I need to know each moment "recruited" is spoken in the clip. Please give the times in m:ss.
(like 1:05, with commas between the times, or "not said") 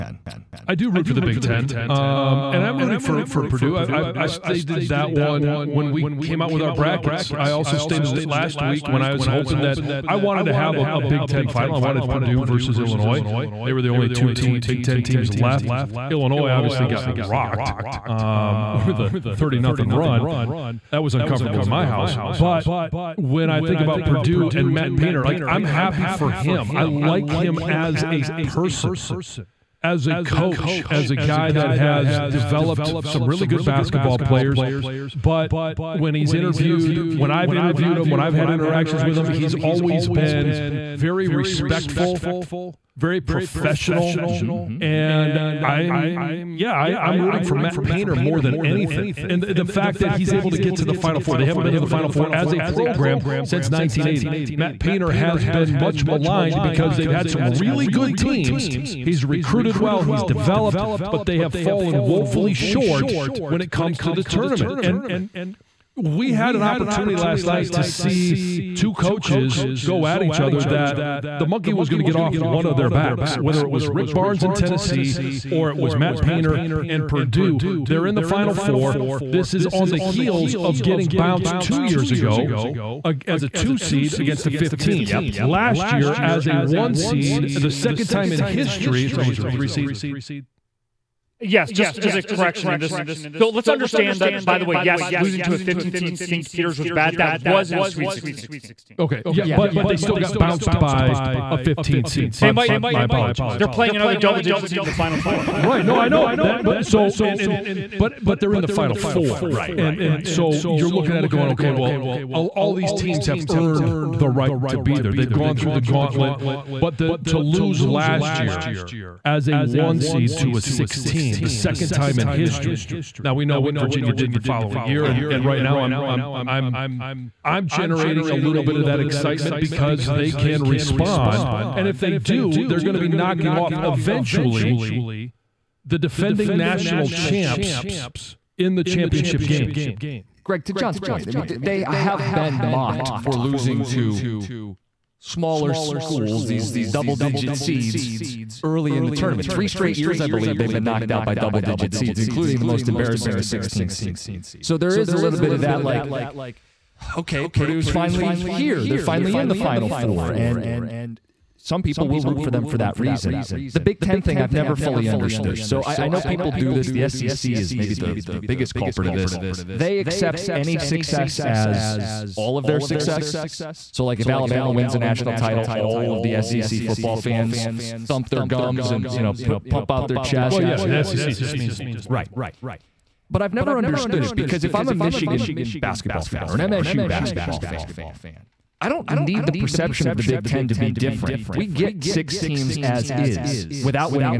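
0:59.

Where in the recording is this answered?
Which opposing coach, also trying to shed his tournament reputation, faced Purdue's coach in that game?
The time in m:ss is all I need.
1:13.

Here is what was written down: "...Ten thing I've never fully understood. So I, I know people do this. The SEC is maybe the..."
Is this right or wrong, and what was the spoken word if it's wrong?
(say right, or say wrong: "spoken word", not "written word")
right.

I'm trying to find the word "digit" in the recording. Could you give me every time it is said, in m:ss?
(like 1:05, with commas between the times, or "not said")
1:44, 2:27, 2:31.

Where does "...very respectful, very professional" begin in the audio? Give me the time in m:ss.
0:40.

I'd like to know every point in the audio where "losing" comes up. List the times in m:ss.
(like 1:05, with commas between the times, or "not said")
1:35, 2:23.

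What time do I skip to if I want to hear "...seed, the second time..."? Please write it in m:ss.
1:26.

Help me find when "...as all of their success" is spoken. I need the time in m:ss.
2:51.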